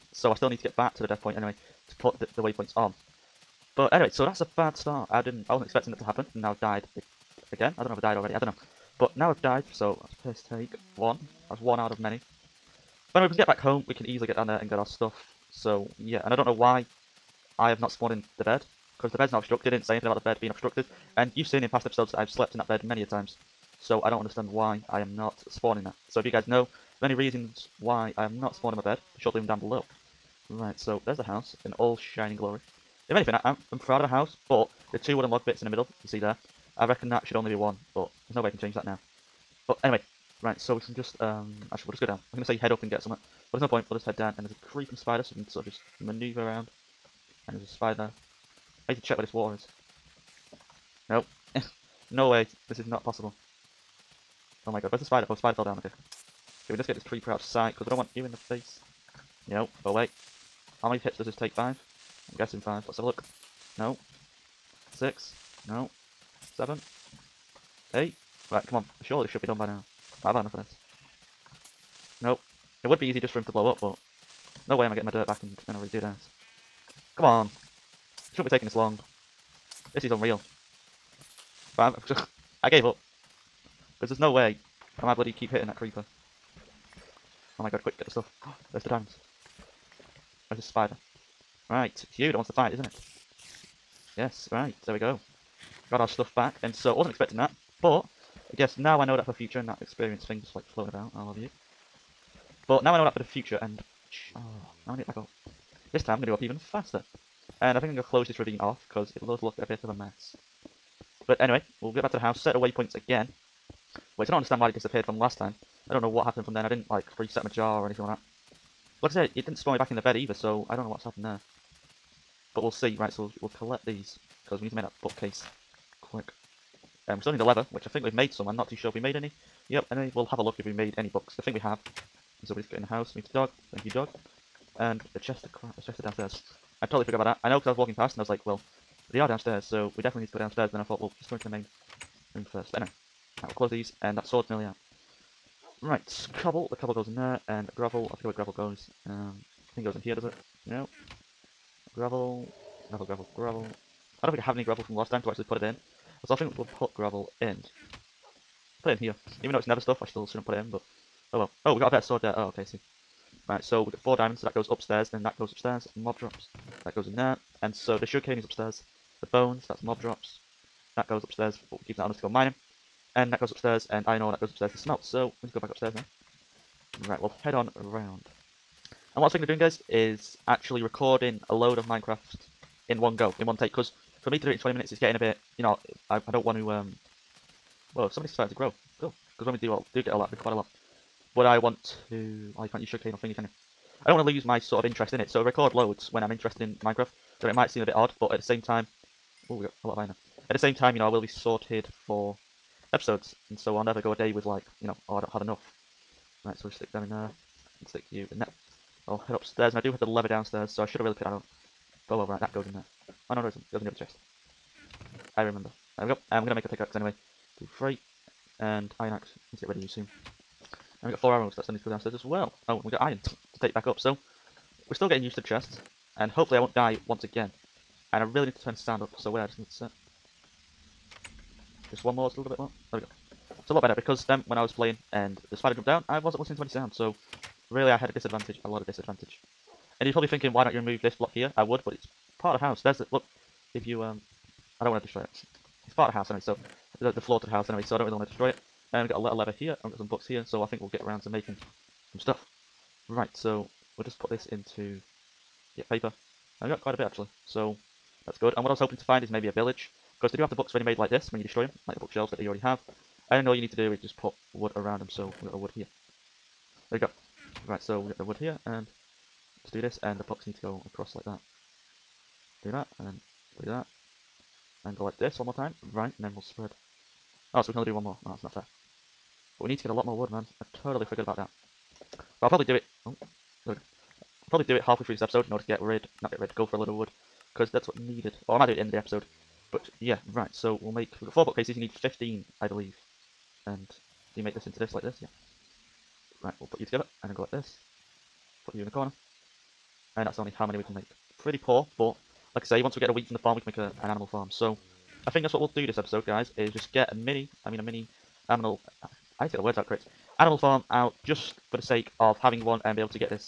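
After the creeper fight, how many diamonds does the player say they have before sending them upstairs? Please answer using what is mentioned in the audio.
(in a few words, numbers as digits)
4.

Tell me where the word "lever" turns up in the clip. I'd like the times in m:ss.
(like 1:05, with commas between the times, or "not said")
3:30, 4:09.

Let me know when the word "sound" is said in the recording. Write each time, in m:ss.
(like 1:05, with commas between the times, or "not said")
3:48, 3:56.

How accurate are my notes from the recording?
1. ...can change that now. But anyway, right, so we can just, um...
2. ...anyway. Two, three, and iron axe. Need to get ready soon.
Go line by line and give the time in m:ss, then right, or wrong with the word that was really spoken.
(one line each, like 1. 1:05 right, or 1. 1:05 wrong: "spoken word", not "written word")
1. 0:38 right
2. 3:36 right.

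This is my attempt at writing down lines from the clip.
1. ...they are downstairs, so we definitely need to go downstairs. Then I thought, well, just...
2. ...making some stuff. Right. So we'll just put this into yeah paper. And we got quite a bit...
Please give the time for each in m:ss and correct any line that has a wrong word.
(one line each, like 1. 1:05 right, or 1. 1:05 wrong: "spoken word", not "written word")
1. 2:19 right
2. 4:11 right.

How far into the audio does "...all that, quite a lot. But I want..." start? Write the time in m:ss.
3:10.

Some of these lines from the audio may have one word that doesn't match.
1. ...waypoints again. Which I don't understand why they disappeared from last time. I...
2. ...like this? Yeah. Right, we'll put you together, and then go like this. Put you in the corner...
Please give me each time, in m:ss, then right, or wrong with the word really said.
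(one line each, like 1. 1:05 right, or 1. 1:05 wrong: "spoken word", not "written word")
1. 1:52 right
2. 4:54 right.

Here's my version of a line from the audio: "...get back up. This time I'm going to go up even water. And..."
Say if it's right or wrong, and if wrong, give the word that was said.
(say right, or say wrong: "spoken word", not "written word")
wrong: "faster", not "water".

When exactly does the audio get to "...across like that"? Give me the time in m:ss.
4:30.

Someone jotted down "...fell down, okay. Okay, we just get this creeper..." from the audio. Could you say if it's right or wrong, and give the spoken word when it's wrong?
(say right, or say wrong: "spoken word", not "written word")
right.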